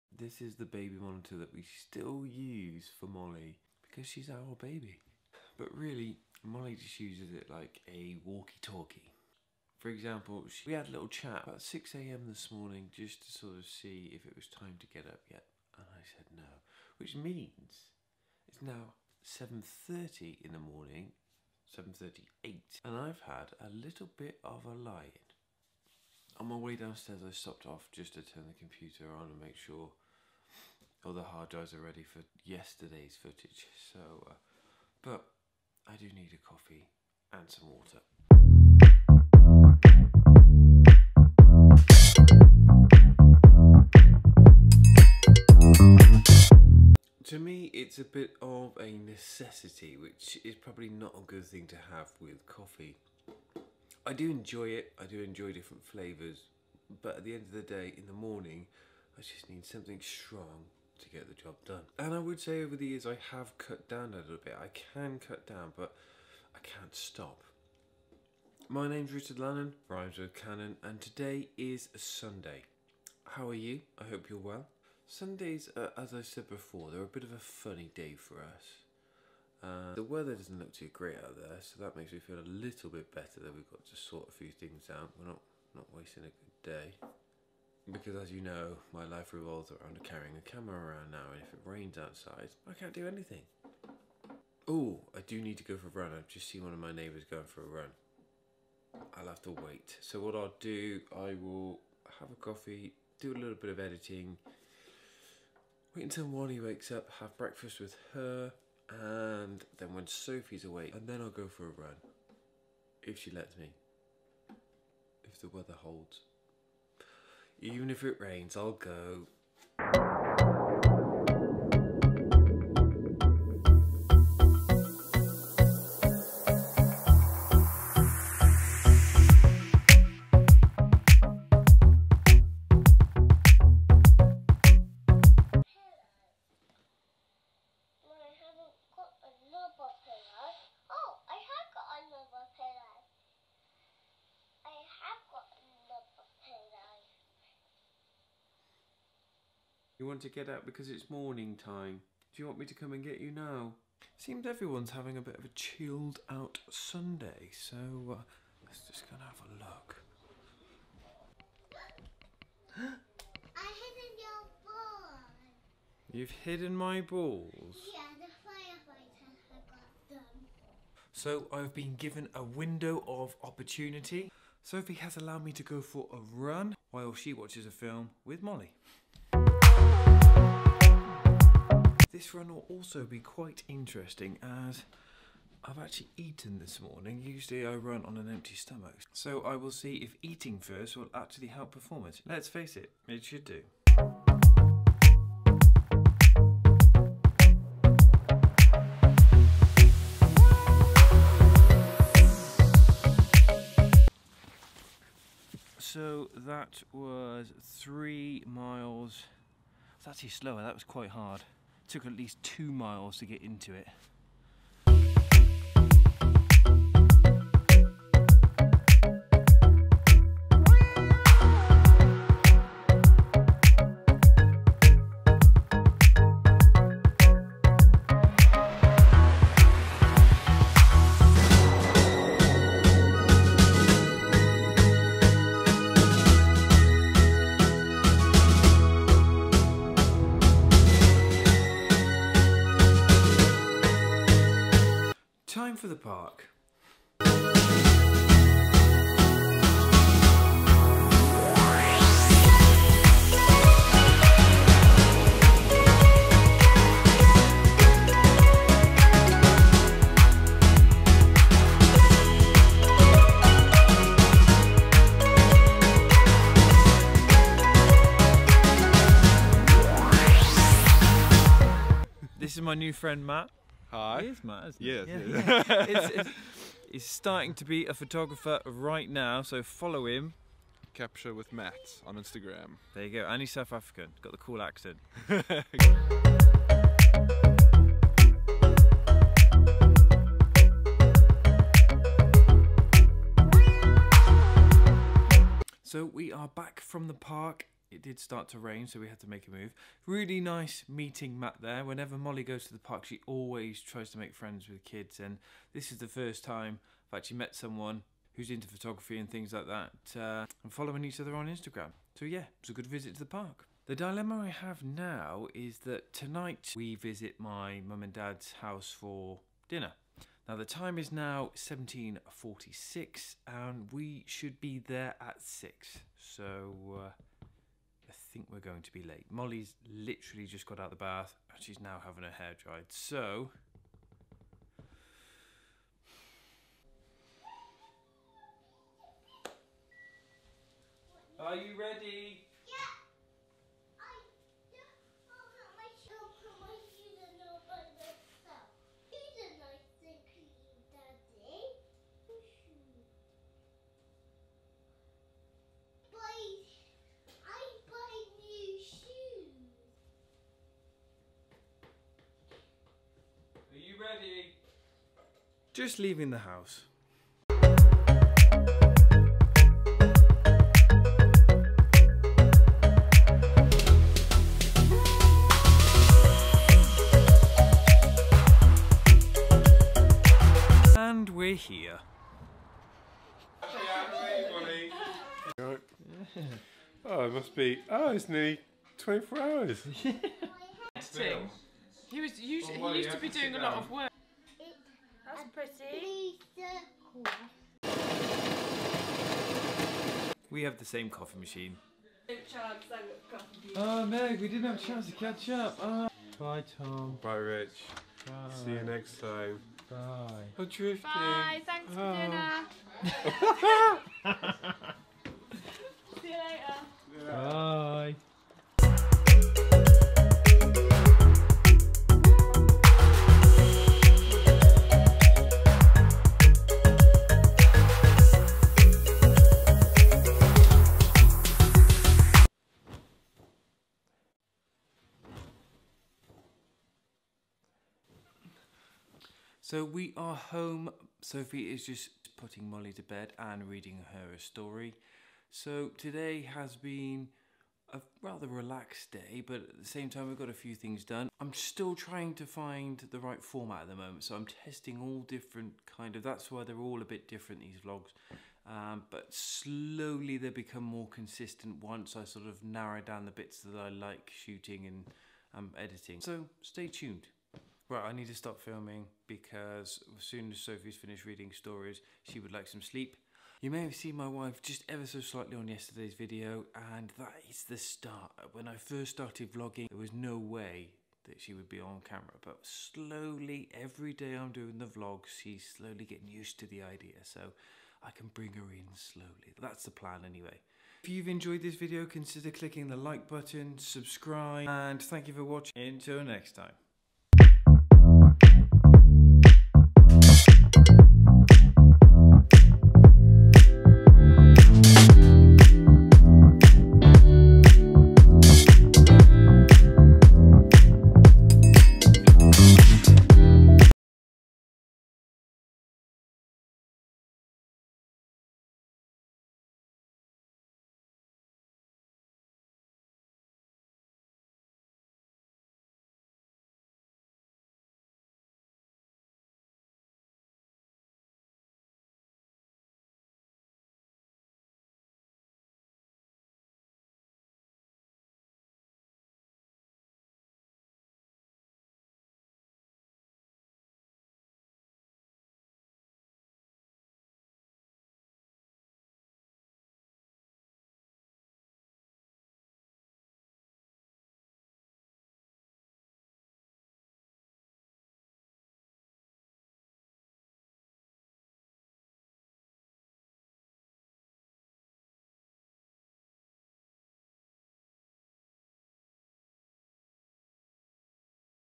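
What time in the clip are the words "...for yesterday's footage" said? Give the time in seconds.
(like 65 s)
32 s.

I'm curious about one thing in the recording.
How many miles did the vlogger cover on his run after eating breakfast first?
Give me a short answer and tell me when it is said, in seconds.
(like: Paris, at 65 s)
3, at 207 s.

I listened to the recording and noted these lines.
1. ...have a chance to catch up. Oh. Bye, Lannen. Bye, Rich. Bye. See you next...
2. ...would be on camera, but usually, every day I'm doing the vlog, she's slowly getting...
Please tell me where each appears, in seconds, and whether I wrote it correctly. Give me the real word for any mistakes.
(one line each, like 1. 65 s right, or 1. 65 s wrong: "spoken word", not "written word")
1. 404 s wrong: "Tom", not "Lannen"
2. 481 s wrong: "slowly", not "usually".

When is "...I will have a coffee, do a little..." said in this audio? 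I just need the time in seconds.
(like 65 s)
101 s.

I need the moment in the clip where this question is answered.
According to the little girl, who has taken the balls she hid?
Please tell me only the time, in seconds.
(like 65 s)
168 s.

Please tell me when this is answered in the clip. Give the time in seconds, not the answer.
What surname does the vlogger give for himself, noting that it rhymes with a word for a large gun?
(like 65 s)
69 s.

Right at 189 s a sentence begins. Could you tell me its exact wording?
So I will see if eating first will actually help performance.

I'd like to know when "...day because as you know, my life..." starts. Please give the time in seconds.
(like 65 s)
86 s.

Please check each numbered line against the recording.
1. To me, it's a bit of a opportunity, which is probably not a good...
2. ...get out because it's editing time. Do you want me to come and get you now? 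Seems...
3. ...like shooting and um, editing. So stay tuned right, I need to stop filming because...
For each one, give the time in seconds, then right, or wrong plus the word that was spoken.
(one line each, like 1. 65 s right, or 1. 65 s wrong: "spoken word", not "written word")
1. 47 s wrong: "necessity", not "opportunity"
2. 150 s wrong: "morning", not "editing"
3. 463 s right.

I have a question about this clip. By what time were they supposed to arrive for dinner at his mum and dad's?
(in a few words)
6.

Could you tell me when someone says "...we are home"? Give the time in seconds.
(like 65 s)
439 s.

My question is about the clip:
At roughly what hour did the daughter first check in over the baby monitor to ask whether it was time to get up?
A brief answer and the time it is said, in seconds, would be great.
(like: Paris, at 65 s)
6 a.m., at 11 s.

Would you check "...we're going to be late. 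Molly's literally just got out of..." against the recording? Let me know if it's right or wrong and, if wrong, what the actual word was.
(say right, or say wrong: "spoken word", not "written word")
right.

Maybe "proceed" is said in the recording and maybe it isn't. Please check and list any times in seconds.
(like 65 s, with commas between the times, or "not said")
not said.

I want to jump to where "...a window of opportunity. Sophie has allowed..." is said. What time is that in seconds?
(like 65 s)
172 s.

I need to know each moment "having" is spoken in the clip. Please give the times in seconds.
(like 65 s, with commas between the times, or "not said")
154 s, 332 s.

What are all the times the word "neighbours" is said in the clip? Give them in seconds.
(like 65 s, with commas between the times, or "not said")
96 s.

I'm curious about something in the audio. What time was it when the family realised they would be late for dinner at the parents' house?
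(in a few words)
17:46.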